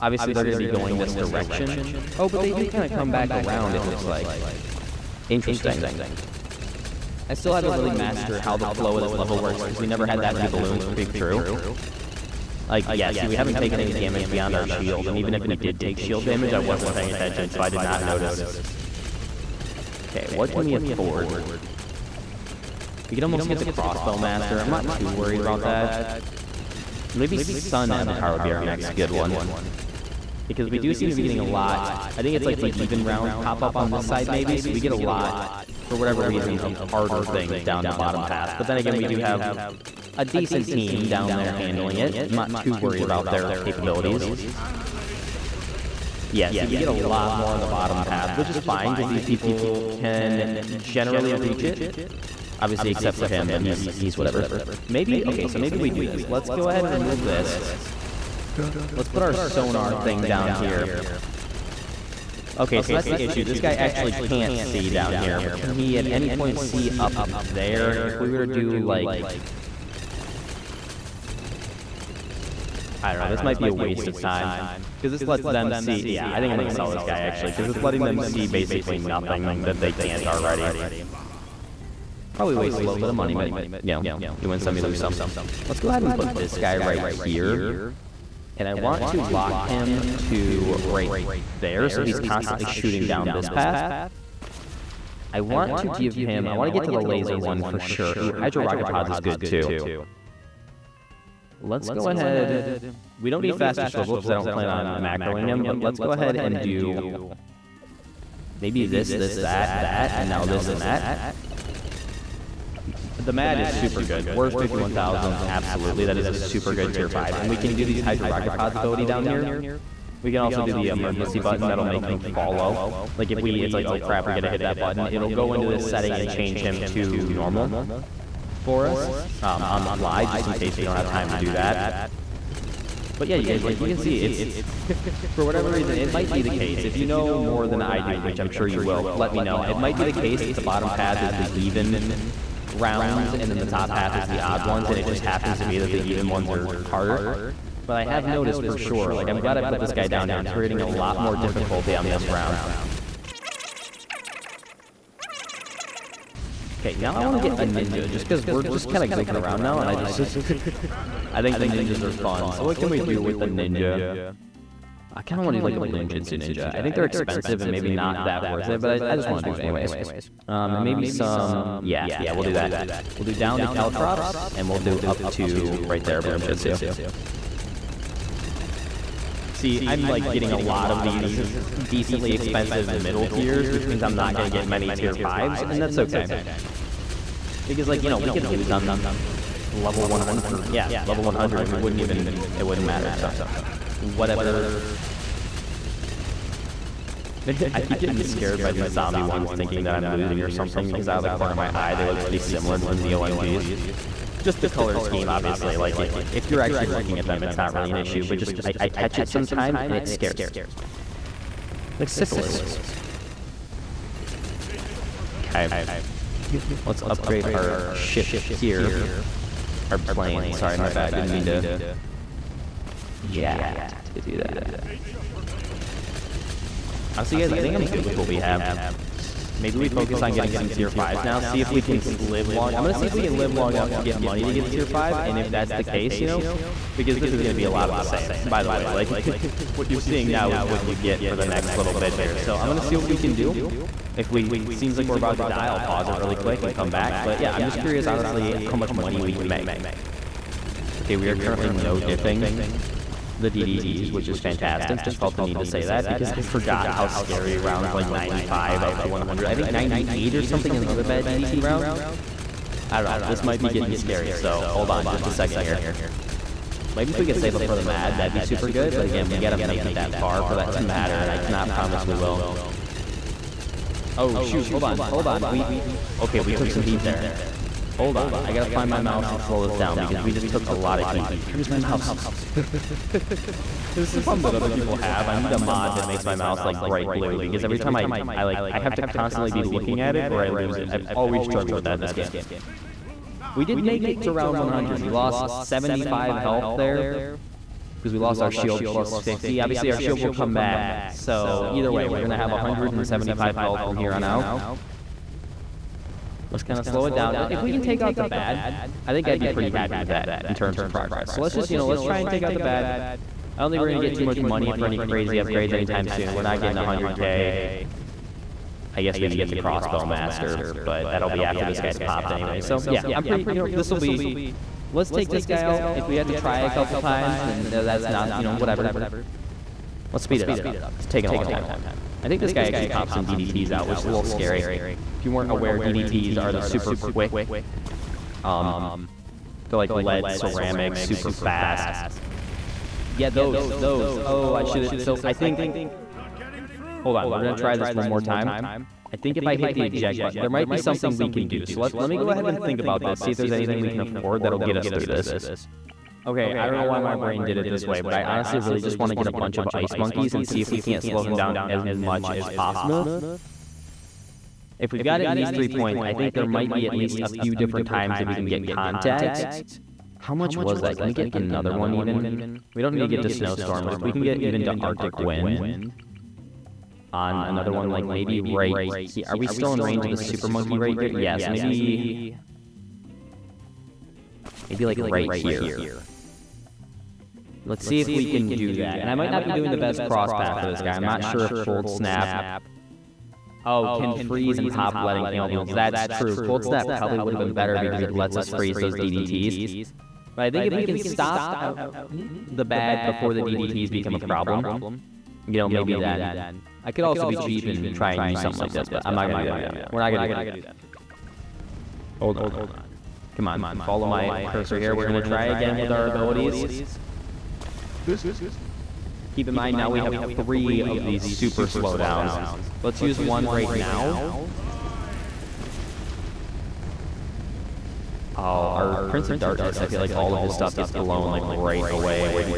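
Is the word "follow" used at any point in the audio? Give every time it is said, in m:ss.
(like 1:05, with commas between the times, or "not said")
2:02, 6:53.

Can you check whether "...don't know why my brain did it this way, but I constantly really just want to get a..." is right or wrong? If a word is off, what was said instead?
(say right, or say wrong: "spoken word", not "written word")
wrong: "honestly", not "constantly".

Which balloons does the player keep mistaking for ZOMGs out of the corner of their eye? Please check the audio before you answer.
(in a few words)
zombie ones.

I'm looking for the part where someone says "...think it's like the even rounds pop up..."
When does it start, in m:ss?
0:32.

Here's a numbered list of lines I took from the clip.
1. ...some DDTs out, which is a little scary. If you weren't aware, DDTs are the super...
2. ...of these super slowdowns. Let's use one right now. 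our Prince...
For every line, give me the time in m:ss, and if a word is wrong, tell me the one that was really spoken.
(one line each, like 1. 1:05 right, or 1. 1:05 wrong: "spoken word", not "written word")
1. 5:33 right
2. 7:00 right.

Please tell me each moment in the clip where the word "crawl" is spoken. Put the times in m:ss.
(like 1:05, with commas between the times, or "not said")
not said.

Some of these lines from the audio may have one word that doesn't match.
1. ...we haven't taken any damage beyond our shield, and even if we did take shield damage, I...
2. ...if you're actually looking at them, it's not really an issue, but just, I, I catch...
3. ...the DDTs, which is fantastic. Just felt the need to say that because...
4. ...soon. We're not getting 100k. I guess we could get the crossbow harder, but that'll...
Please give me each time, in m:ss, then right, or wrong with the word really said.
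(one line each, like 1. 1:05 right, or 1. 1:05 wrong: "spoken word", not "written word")
1. 0:13 right
2. 3:26 right
3. 4:13 right
4. 5:16 wrong: "master", not "harder".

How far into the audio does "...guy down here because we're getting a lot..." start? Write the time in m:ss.
2:29.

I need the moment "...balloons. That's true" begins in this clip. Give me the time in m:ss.
6:35.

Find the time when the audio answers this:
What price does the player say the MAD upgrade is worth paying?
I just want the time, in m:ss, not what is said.
1:54.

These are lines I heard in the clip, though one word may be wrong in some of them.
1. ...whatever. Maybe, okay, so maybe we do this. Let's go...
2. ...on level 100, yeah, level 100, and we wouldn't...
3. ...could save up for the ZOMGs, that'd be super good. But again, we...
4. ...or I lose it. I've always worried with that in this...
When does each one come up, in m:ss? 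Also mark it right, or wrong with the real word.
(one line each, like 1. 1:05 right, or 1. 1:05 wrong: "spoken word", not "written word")
1. 0:54 right
2. 3:08 right
3. 4:27 wrong: "MAD", not "ZOMGs"
4. 4:50 wrong: "struggled", not "worried".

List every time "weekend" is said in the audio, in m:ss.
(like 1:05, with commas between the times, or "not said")
not said.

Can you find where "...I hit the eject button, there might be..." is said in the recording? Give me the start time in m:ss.
5:49.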